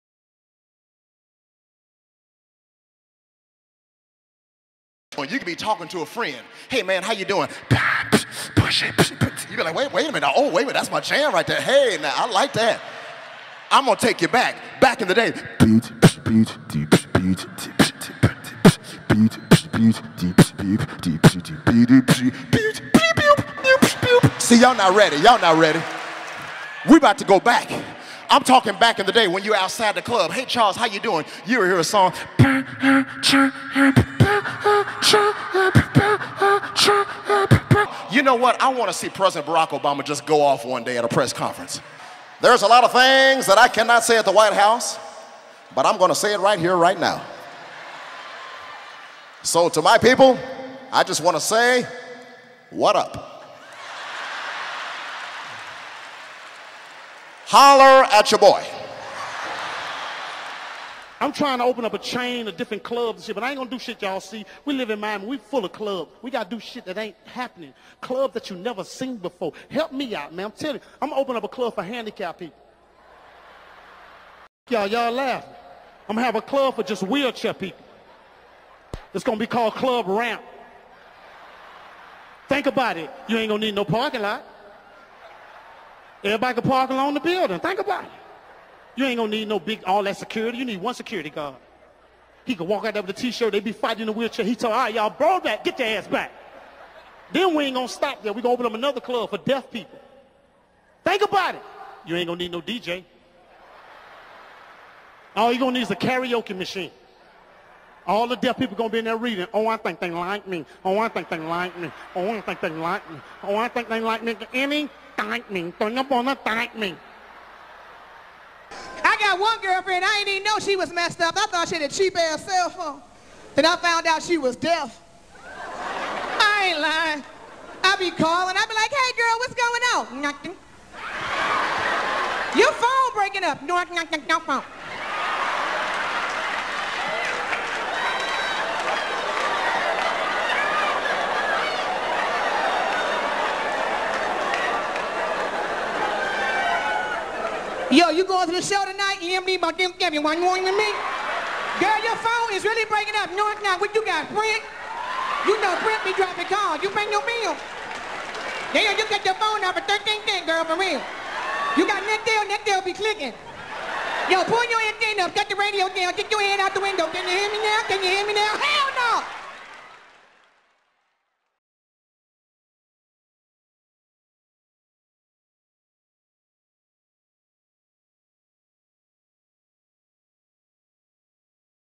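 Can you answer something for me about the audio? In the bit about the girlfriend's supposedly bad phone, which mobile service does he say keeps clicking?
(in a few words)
Nextel.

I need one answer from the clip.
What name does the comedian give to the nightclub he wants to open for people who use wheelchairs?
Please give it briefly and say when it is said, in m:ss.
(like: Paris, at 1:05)
Club Ramp, at 1:19.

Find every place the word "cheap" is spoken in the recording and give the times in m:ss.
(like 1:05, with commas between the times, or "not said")
2:01.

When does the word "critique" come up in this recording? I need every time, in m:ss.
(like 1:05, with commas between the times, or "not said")
not said.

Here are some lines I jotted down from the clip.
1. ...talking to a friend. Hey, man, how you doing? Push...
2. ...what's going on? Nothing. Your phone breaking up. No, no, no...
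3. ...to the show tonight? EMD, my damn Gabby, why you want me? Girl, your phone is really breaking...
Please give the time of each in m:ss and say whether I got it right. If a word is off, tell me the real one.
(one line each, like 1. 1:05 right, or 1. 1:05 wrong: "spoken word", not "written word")
1. 0:05 right
2. 2:09 right
3. 2:28 right.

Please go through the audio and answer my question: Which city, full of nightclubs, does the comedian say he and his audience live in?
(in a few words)
Miami.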